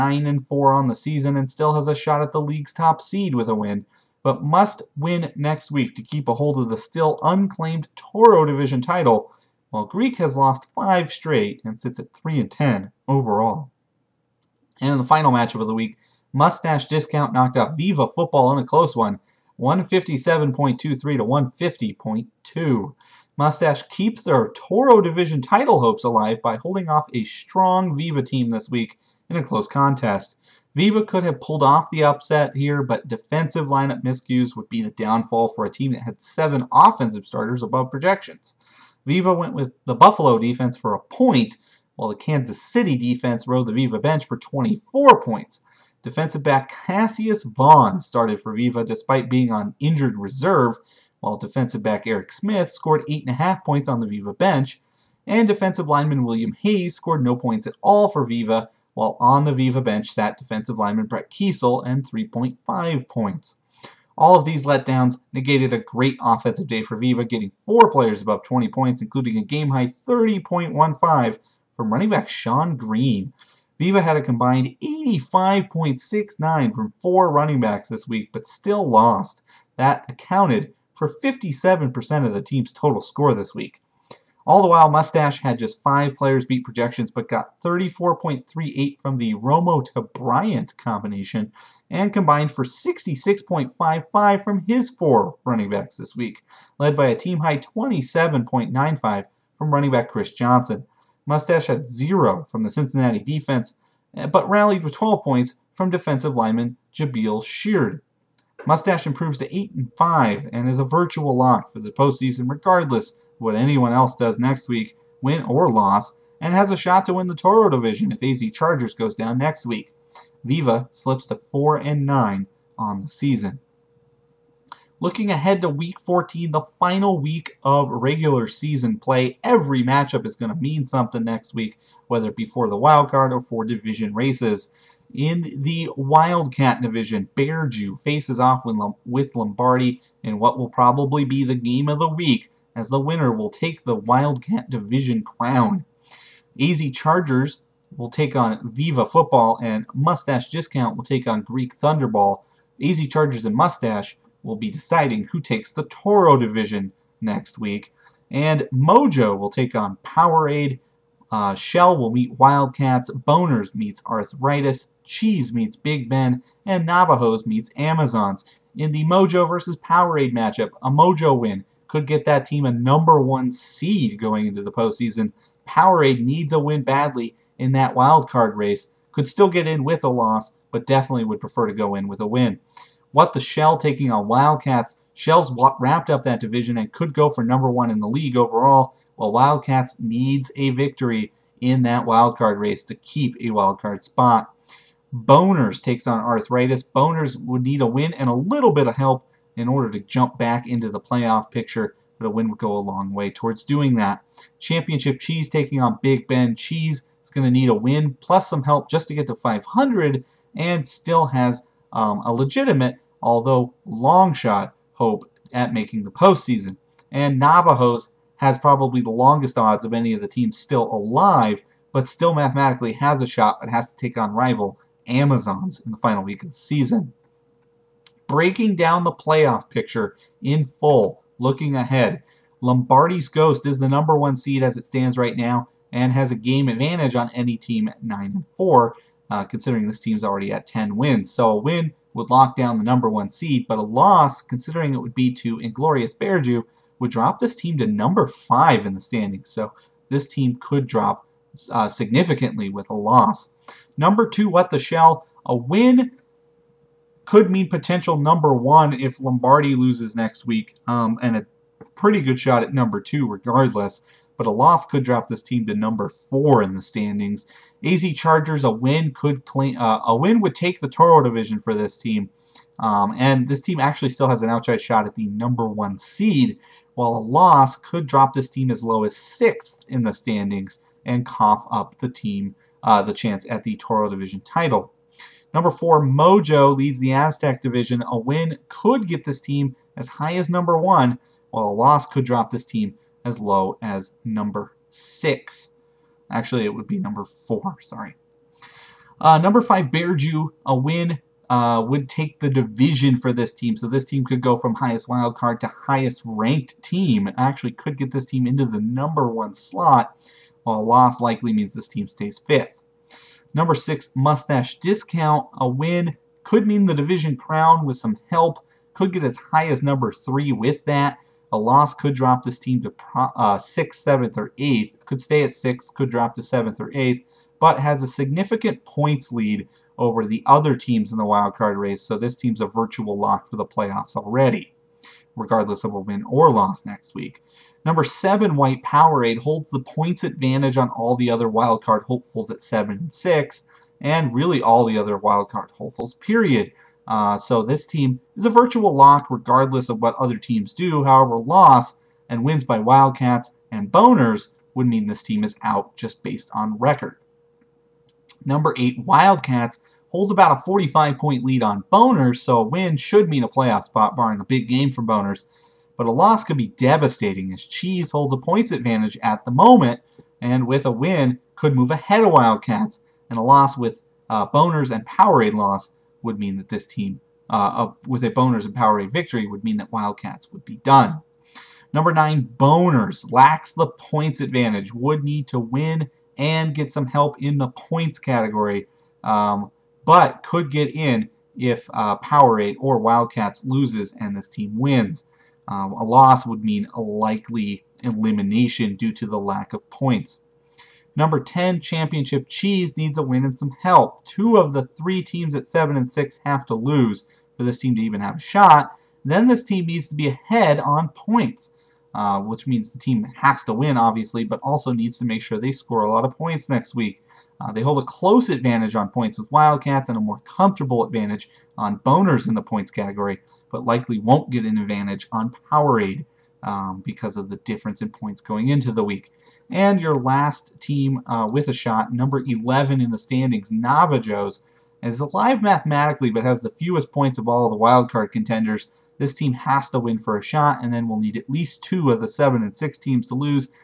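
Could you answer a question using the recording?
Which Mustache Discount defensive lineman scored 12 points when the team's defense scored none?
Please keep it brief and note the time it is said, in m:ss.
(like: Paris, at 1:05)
Jabaal Sheard, at 1:46.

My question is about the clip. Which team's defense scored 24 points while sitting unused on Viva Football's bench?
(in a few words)
Kansas City.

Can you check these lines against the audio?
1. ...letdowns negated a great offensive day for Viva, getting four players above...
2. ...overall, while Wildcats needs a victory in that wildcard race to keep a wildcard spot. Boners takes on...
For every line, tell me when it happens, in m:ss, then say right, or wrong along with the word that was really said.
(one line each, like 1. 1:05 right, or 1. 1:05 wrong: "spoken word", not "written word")
1. 1:04 right
2. 3:08 right.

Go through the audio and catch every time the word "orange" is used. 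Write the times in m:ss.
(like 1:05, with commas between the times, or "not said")
not said.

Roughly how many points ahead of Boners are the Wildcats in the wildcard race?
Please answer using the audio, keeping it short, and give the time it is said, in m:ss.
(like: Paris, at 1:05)
45, at 6:00.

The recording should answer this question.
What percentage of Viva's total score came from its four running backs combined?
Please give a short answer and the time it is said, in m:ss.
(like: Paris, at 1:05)
57%, at 1:21.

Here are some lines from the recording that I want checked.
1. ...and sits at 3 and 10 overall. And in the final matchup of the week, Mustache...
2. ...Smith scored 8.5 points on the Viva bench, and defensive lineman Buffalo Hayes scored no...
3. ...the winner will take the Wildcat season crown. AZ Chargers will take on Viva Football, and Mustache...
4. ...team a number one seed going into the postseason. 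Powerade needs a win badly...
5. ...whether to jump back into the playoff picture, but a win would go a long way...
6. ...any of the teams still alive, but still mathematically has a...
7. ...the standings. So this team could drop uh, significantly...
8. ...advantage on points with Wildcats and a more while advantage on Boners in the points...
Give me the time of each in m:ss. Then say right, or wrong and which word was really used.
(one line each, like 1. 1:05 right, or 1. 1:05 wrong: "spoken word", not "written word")
1. 0:11 right
2. 0:52 wrong: "William", not "Buffalo"
3. 2:22 wrong: "division", not "season"
4. 2:52 right
5. 3:19 wrong: "order", not "whether"
6. 3:39 right
7. 4:08 right
8. 6:58 wrong: "comfortable", not "while".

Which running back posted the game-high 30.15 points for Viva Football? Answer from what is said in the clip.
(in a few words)
Shonn Greene.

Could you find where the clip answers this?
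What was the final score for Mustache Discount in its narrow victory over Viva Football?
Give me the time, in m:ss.
0:19.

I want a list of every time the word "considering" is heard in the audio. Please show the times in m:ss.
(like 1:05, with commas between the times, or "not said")
3:59, 4:04.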